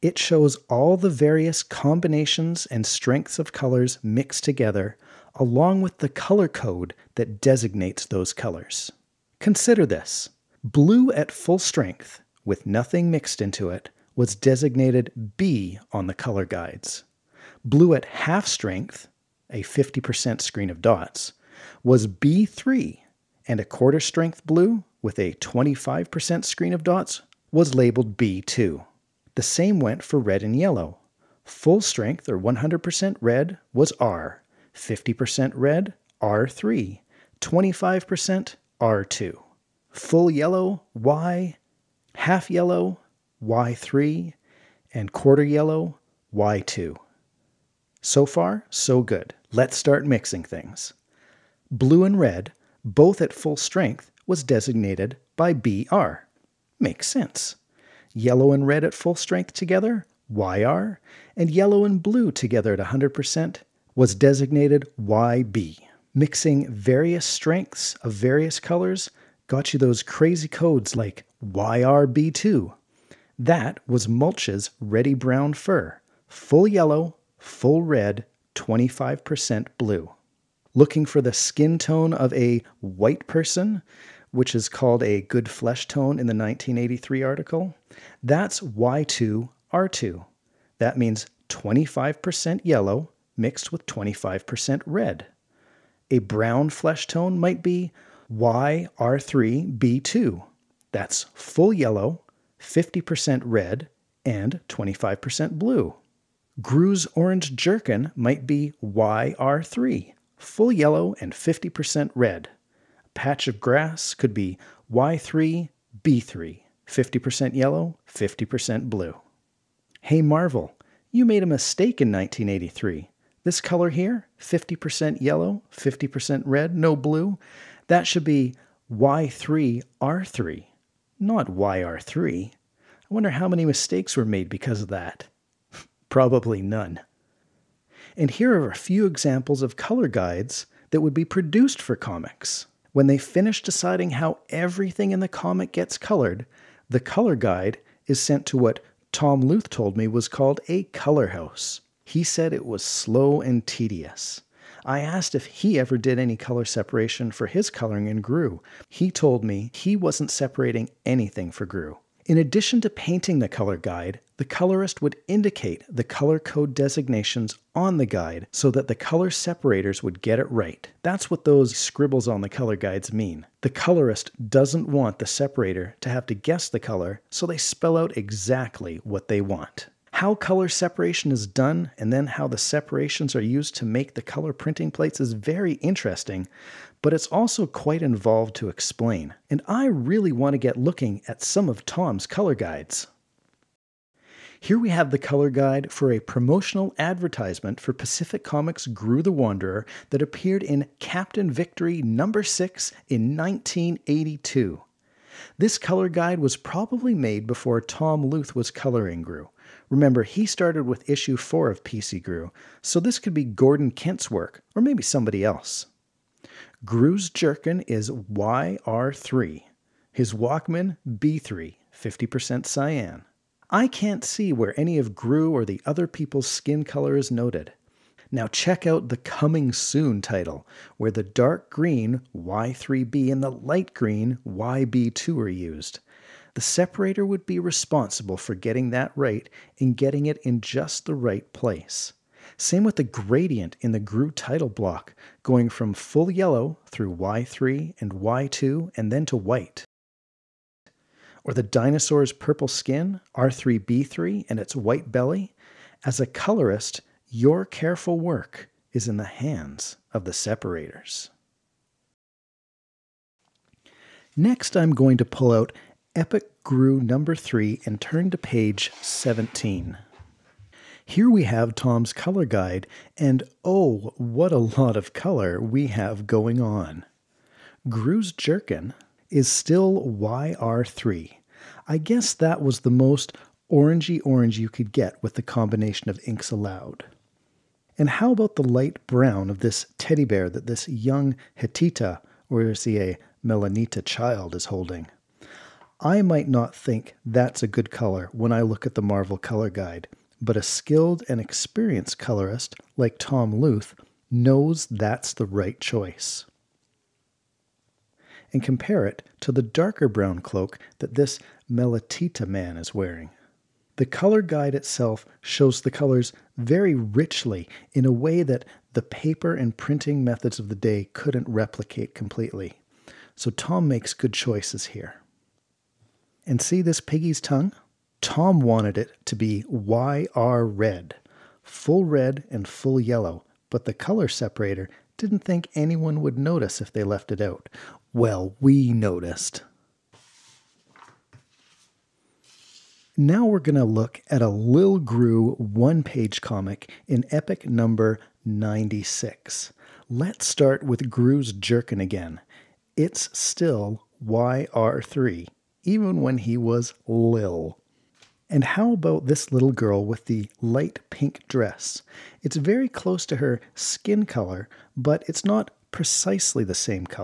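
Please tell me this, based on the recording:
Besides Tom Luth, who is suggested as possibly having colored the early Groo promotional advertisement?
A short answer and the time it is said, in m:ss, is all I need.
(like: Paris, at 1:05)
Gordon Kent, at 3:33.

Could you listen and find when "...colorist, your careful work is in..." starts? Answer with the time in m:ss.
4:16.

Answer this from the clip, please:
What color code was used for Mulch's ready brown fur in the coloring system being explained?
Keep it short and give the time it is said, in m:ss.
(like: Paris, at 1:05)
YRB2, at 1:11.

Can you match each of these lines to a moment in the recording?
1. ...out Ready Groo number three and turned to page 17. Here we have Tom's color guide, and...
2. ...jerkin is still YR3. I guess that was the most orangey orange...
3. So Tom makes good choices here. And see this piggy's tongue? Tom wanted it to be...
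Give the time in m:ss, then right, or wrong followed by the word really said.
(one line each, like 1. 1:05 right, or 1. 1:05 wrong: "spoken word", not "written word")
1. 4:25 wrong: "Epic", not "Ready"
2. 4:38 right
3. 5:23 right.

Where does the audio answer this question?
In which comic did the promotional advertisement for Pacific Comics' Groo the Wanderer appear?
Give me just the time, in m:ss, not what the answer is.
3:20.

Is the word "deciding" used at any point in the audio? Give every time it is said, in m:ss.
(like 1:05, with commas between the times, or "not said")
2:23.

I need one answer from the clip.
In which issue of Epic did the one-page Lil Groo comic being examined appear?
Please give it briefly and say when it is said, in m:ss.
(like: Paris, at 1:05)
96, at 5:48.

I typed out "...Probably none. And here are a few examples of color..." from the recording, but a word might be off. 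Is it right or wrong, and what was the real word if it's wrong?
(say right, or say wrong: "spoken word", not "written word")
right.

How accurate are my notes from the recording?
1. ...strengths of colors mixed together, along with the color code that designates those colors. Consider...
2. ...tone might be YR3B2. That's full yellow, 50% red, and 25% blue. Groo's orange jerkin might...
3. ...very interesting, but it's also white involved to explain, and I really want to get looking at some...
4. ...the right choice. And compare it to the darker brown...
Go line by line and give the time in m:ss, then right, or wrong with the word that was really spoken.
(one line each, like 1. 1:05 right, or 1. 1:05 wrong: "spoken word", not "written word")
1. 0:02 right
2. 1:37 right
3. 3:05 wrong: "quite", not "white"
4. 5:05 right.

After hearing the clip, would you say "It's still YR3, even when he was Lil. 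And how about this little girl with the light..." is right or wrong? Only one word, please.
right.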